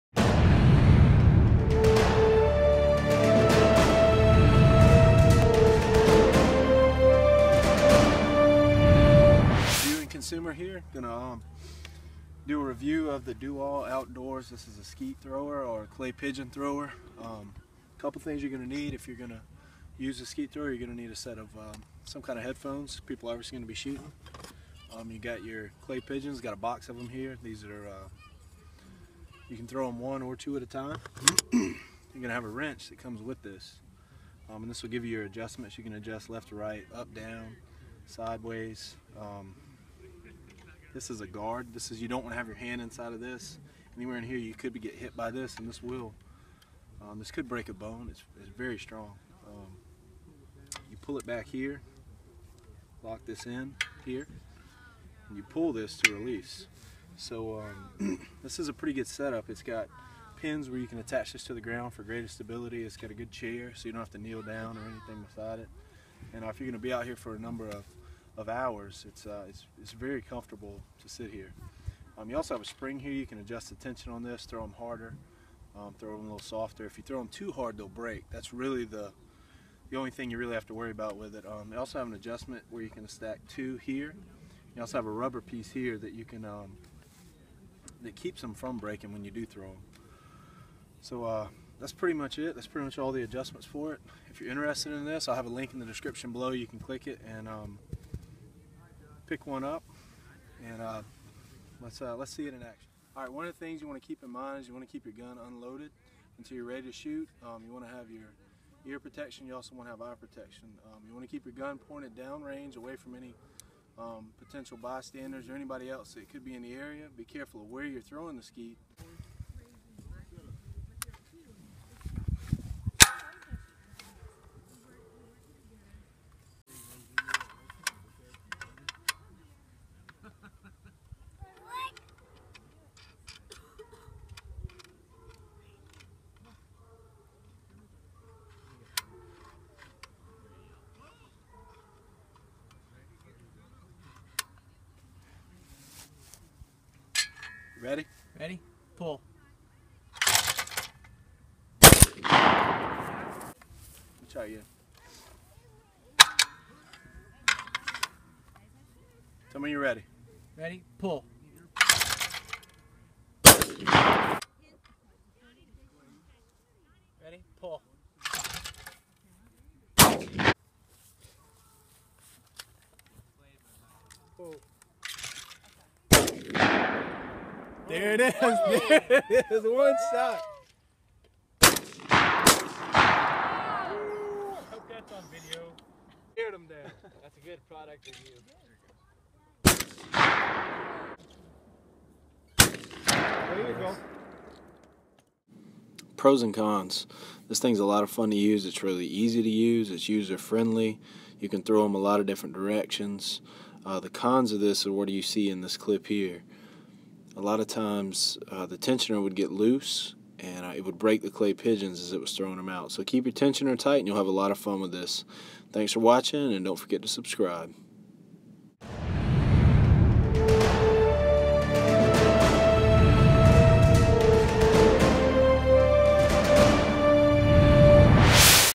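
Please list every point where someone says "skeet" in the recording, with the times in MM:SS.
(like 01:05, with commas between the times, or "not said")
00:14, 00:20, 01:58.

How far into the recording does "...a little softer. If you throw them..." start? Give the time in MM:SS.
01:16.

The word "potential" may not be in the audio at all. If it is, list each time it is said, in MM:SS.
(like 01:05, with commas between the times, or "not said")
01:54.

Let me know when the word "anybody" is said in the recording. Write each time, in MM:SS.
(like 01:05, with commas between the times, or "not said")
01:55.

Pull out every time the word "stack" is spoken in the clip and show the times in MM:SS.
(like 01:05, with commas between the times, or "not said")
01:23.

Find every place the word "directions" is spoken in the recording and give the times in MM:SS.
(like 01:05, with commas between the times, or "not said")
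03:22.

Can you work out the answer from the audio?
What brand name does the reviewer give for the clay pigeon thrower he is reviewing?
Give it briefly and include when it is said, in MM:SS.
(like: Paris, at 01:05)
Dual Outdoors, at 00:13.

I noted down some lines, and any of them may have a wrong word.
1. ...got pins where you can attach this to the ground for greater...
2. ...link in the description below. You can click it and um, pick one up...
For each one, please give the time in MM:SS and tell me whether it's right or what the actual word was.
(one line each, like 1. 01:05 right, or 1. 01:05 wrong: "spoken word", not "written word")
1. 00:59 right
2. 01:35 right.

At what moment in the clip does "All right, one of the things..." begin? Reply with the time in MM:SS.
01:43.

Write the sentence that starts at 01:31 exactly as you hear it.
So uh, that's pretty much it.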